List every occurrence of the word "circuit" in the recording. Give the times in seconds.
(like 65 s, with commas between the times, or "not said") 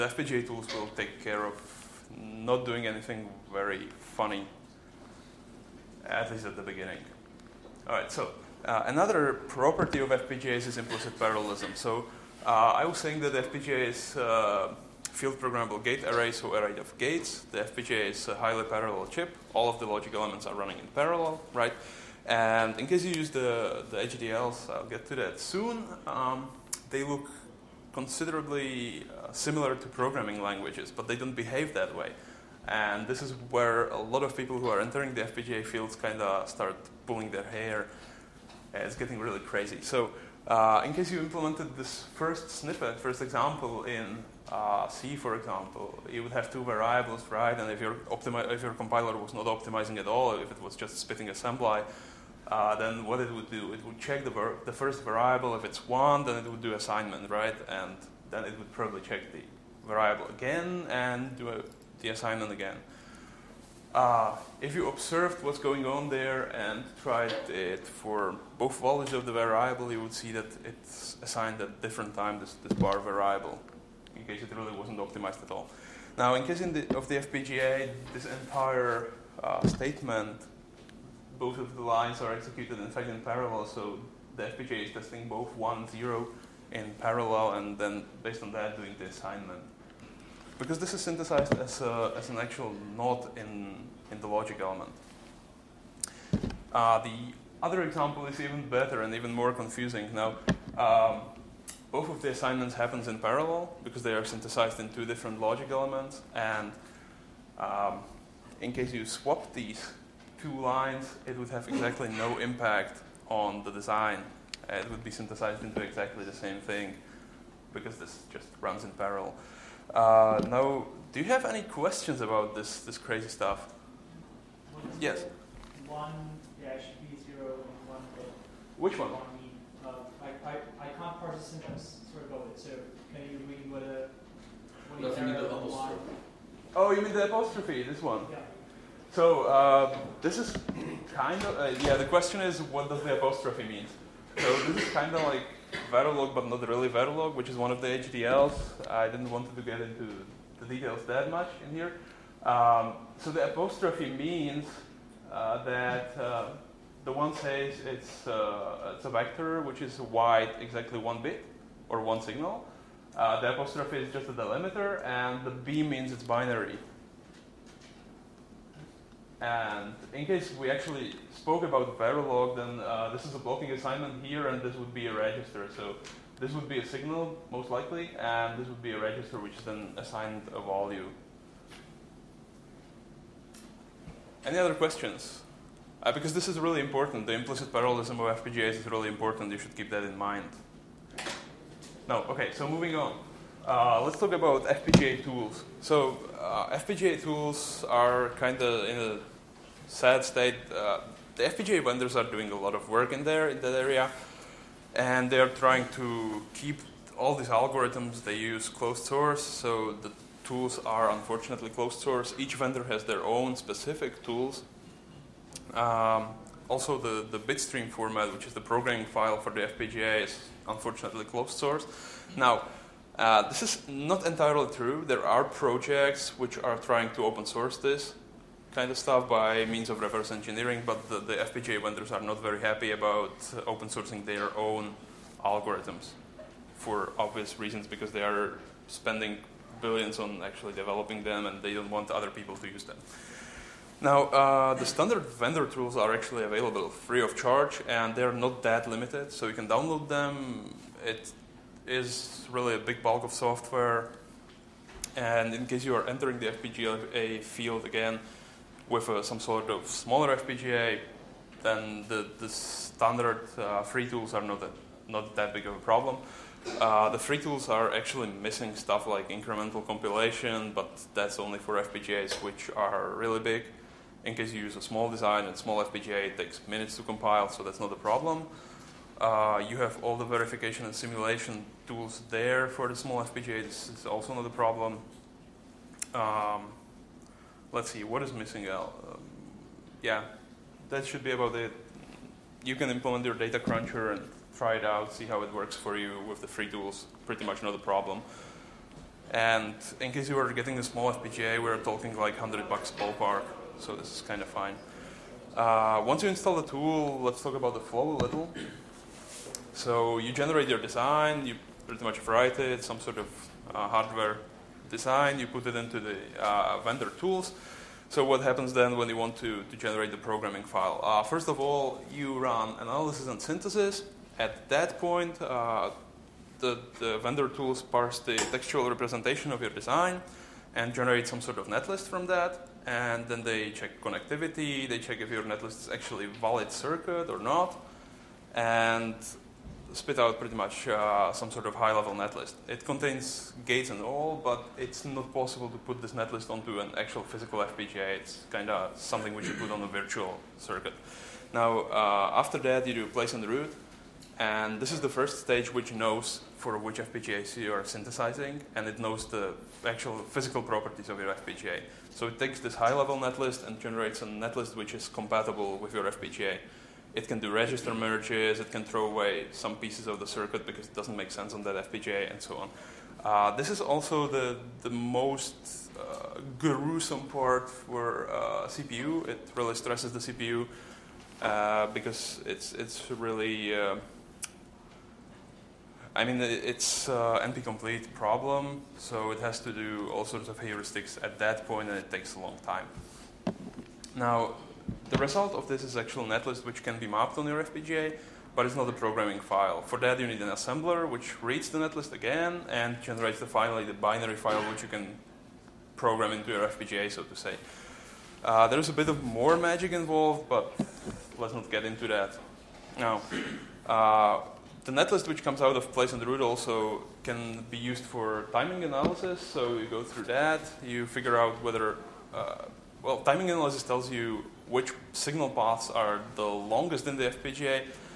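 336 s, 350 s, 370 s.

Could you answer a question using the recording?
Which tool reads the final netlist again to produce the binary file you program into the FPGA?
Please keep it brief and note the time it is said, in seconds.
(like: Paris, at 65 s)
assembler, at 400 s.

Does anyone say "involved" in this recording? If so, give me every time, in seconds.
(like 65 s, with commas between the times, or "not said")
409 s.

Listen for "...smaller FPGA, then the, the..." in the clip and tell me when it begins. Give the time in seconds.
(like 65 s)
259 s.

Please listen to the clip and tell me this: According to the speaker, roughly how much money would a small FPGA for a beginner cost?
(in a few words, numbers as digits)
100 bucks.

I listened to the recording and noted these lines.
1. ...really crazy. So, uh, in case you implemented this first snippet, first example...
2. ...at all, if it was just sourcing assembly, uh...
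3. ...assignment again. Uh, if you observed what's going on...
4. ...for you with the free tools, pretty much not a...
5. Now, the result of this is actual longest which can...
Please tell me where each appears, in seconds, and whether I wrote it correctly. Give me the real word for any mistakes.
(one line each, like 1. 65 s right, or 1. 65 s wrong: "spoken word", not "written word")
1. 39 s right
2. 49 s wrong: "spitting", not "sourcing"
3. 62 s right
4. 295 s right
5. 394 s wrong: "netlist", not "longest".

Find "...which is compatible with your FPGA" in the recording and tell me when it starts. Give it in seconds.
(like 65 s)
364 s.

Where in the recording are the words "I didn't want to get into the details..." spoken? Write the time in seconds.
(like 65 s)
148 s.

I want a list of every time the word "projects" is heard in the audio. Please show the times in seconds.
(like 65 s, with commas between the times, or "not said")
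225 s.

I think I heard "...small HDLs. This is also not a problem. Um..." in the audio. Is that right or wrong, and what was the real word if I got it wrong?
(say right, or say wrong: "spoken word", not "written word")
wrong: "FPGA", not "HDLs".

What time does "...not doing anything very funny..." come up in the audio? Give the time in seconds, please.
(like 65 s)
2 s.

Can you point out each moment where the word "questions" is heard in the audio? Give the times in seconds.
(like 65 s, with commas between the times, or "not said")
121 s, 142 s, 184 s.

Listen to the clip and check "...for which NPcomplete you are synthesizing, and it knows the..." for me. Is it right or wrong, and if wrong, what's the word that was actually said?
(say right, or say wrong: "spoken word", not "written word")
wrong: "FPGAs", not "NPcomplete".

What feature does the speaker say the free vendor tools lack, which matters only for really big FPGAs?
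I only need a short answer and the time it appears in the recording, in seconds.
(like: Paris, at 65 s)
incremental compilation, at 269 s.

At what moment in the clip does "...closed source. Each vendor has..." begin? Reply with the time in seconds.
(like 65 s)
211 s.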